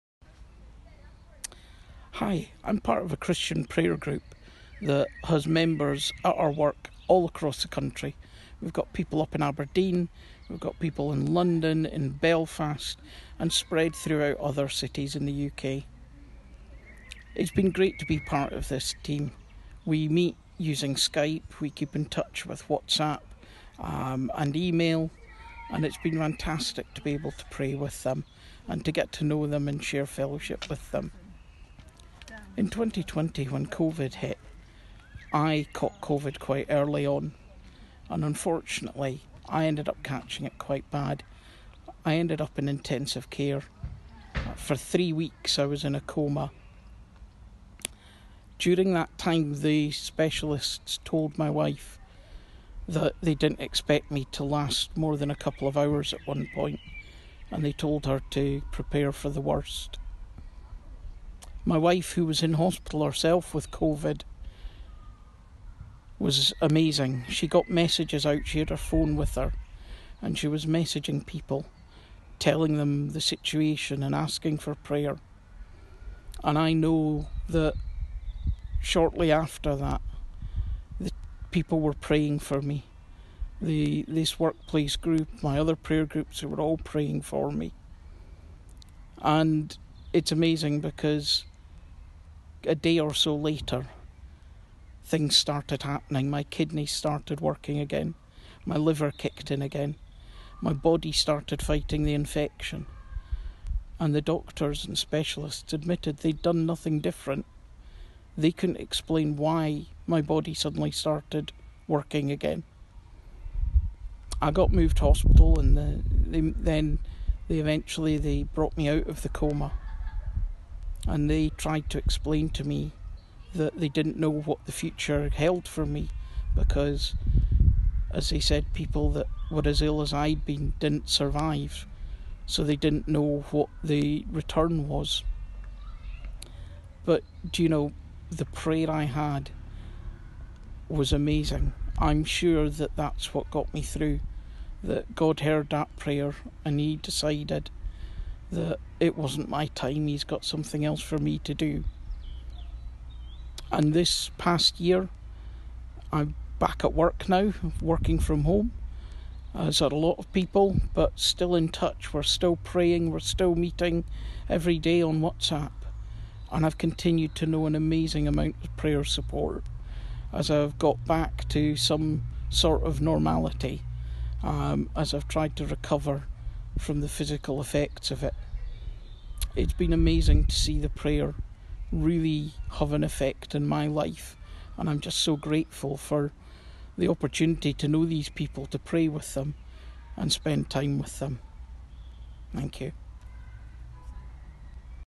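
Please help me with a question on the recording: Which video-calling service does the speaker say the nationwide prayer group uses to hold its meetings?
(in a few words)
Skype.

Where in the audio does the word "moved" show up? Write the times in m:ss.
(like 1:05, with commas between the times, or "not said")
1:54.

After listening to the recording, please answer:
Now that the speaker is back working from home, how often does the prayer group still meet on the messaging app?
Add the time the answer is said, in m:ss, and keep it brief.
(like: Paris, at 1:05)
Every day, at 2:44.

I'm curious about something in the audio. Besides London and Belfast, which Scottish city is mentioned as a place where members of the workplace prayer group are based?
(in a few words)
Aberdeen.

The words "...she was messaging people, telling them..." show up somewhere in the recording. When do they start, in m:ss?
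1:10.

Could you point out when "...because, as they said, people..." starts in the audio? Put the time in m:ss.
2:06.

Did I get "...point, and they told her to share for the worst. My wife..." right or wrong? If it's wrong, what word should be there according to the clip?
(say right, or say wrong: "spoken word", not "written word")
wrong: "prepare", not "share".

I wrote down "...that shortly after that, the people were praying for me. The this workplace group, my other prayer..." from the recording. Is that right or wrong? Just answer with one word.
right.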